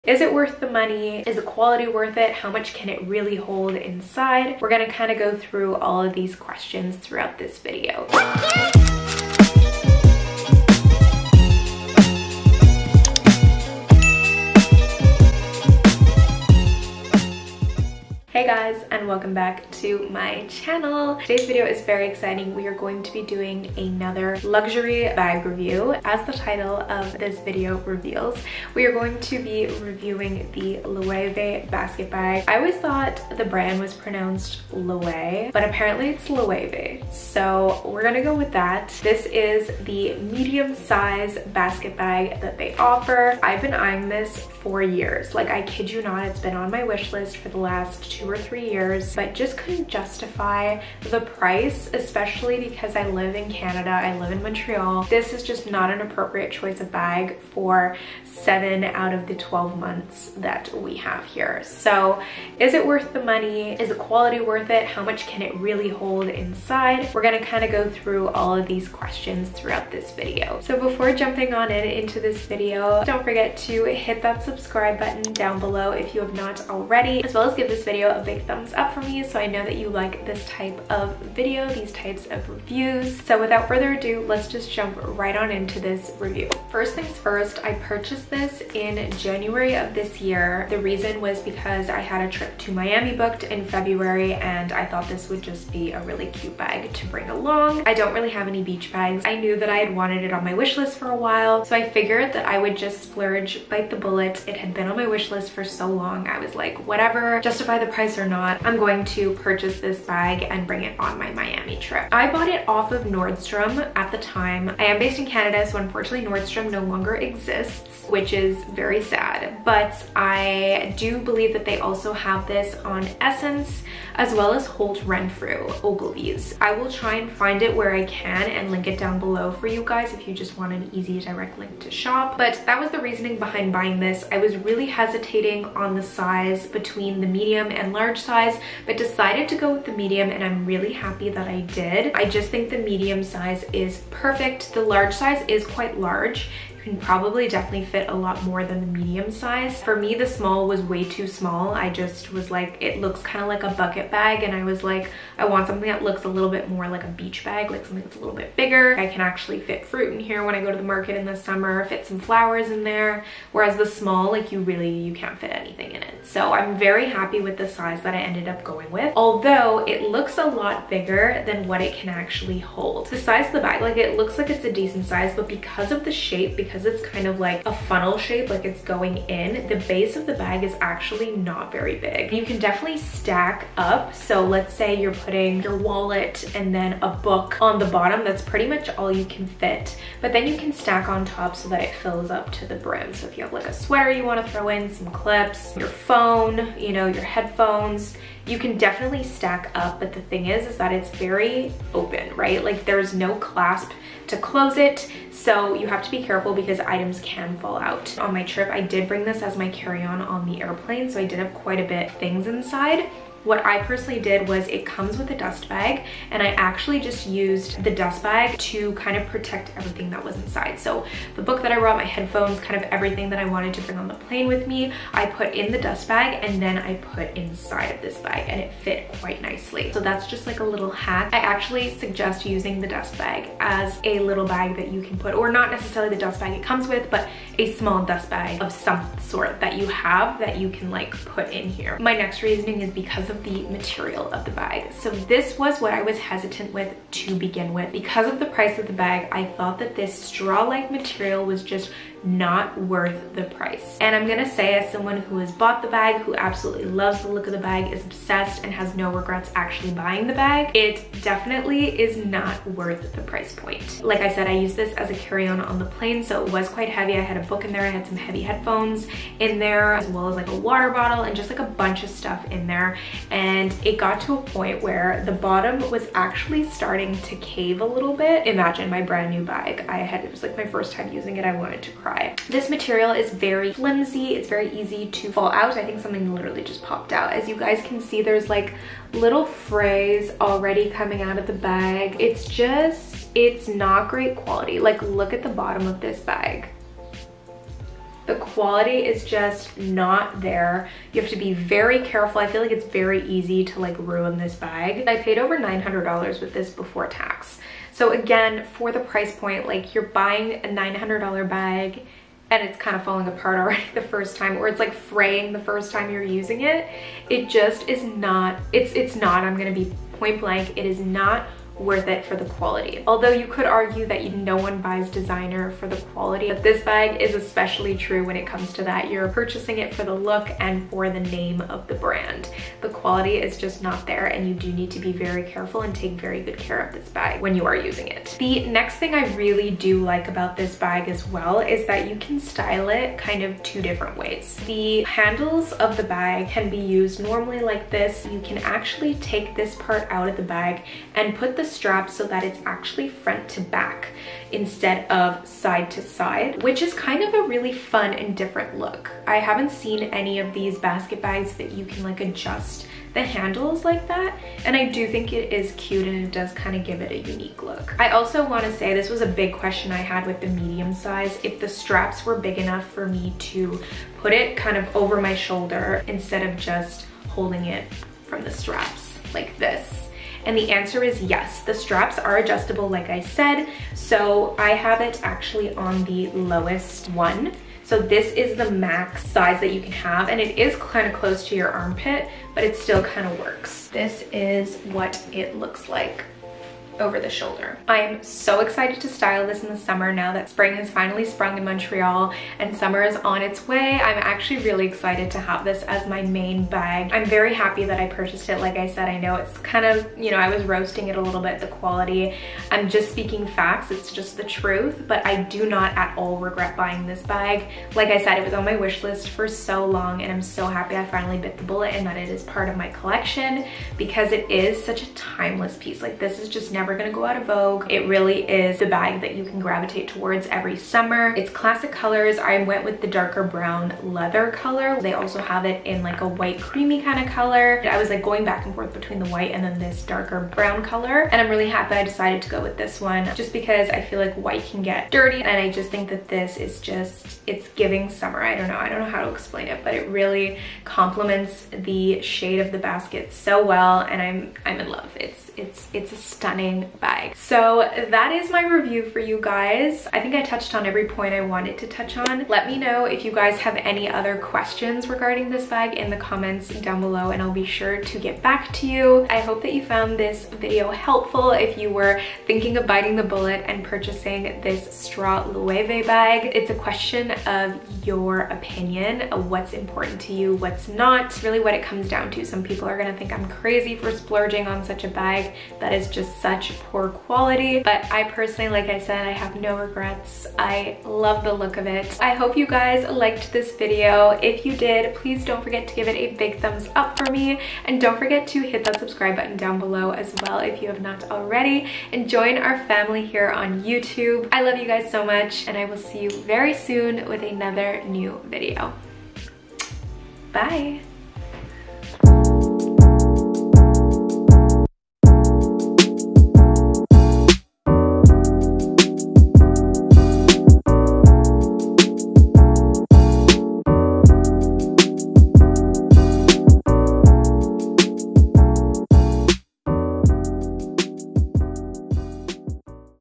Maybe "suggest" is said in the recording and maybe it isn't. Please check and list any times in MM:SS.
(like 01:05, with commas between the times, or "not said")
03:51.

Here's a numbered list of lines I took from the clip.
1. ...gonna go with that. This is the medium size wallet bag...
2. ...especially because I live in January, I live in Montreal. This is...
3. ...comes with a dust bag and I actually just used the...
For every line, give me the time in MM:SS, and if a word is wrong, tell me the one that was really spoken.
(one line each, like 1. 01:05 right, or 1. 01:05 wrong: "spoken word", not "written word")
1. 00:38 wrong: "basket", not "wallet"
2. 00:51 wrong: "Canada", not "January"
3. 03:34 right.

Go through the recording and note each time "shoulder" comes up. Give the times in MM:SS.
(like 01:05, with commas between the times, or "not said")
06:15, 06:37.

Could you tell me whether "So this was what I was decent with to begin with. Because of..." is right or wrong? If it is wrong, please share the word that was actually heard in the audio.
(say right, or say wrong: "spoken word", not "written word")
wrong: "hesitant", not "decent".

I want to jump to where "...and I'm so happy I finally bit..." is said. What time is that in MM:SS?
07:00.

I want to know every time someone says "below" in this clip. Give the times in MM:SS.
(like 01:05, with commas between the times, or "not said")
01:15, 02:09, 07:47, 08:19.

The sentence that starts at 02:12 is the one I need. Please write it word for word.
But that was the reasoning behind buying this.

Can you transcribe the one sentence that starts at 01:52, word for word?
I bought it off of Nordstrom at the time.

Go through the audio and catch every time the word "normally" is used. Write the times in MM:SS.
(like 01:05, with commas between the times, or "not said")
05:47.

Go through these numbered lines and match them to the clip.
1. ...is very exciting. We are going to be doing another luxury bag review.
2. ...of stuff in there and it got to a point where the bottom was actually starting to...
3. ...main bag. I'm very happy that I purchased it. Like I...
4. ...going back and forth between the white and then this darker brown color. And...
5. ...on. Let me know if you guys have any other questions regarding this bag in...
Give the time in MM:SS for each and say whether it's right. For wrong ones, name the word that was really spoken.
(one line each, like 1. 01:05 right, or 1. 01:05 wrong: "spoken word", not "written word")
1. 00:21 right
2. 04:32 right
3. 06:46 right
4. 07:18 right
5. 07:42 right.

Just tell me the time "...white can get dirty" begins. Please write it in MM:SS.
07:24.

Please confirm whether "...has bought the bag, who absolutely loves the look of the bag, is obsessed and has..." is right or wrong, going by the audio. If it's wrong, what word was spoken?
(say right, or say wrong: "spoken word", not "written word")
right.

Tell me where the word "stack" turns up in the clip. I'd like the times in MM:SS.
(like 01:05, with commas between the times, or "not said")
03:02, 03:10, 03:19.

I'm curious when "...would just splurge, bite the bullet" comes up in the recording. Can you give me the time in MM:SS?
01:42.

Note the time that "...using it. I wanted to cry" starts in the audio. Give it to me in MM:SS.
04:41.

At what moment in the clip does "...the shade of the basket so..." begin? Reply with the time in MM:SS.
07:31.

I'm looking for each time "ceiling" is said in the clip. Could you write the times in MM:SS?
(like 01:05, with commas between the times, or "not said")
not said.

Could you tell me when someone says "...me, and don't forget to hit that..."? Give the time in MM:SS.
08:17.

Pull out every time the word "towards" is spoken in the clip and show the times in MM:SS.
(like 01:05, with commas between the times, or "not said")
07:10.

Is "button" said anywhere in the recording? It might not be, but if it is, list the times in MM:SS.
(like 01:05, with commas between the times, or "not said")
01:14, 08:19.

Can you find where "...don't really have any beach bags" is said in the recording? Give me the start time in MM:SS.
01:37.